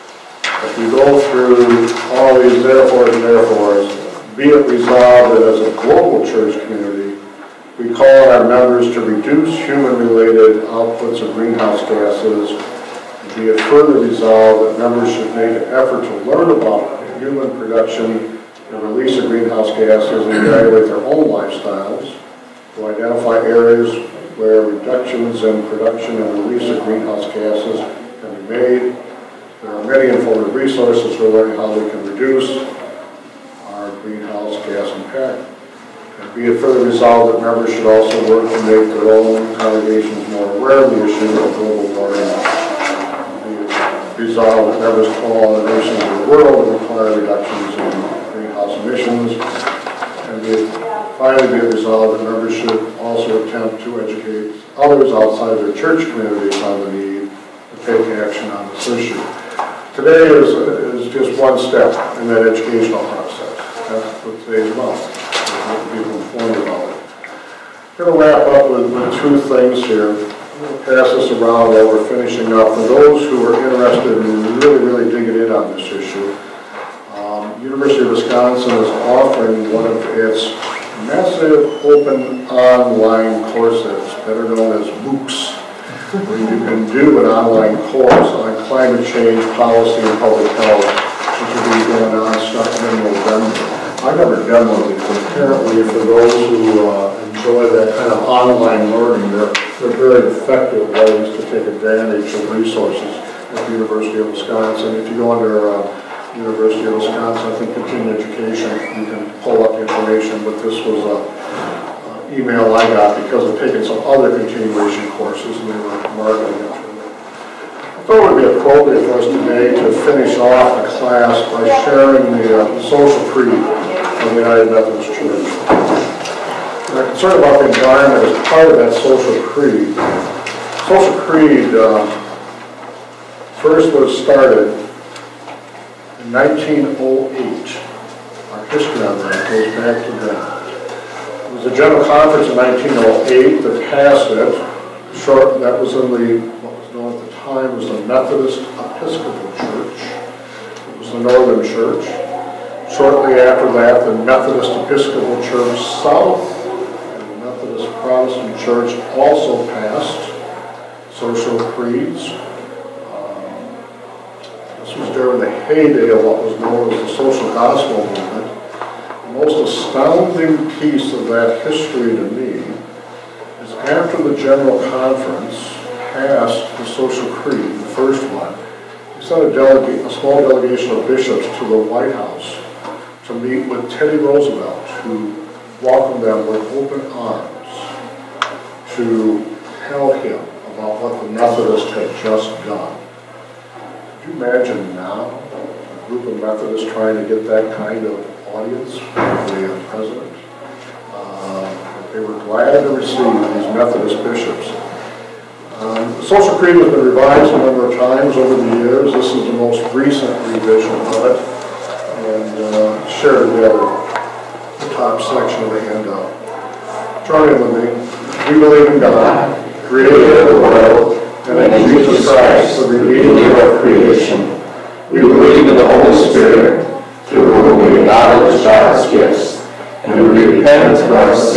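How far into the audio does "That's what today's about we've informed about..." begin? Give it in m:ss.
1:03.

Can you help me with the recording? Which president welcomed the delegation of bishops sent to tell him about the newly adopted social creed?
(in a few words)
Teddy Roosevelt.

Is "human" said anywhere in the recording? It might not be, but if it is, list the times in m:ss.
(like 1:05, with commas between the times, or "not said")
0:09, 0:17.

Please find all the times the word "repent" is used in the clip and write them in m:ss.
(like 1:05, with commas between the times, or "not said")
3:50.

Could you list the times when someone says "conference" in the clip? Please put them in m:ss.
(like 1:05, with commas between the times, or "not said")
2:22, 2:54.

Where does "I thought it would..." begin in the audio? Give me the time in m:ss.
1:56.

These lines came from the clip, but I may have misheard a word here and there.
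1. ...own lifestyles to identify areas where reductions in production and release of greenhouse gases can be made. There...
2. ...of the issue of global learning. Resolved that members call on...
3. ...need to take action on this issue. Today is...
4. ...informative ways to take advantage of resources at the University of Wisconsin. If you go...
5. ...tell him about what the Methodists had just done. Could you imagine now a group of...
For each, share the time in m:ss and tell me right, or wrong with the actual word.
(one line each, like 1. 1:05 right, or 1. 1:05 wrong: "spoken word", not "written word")
1. 0:21 right
2. 0:40 wrong: "warming", not "learning"
3. 0:56 right
4. 1:40 wrong: "effective", not "informative"
5. 3:09 right.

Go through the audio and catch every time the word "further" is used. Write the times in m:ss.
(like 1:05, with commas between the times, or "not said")
0:13, 0:36.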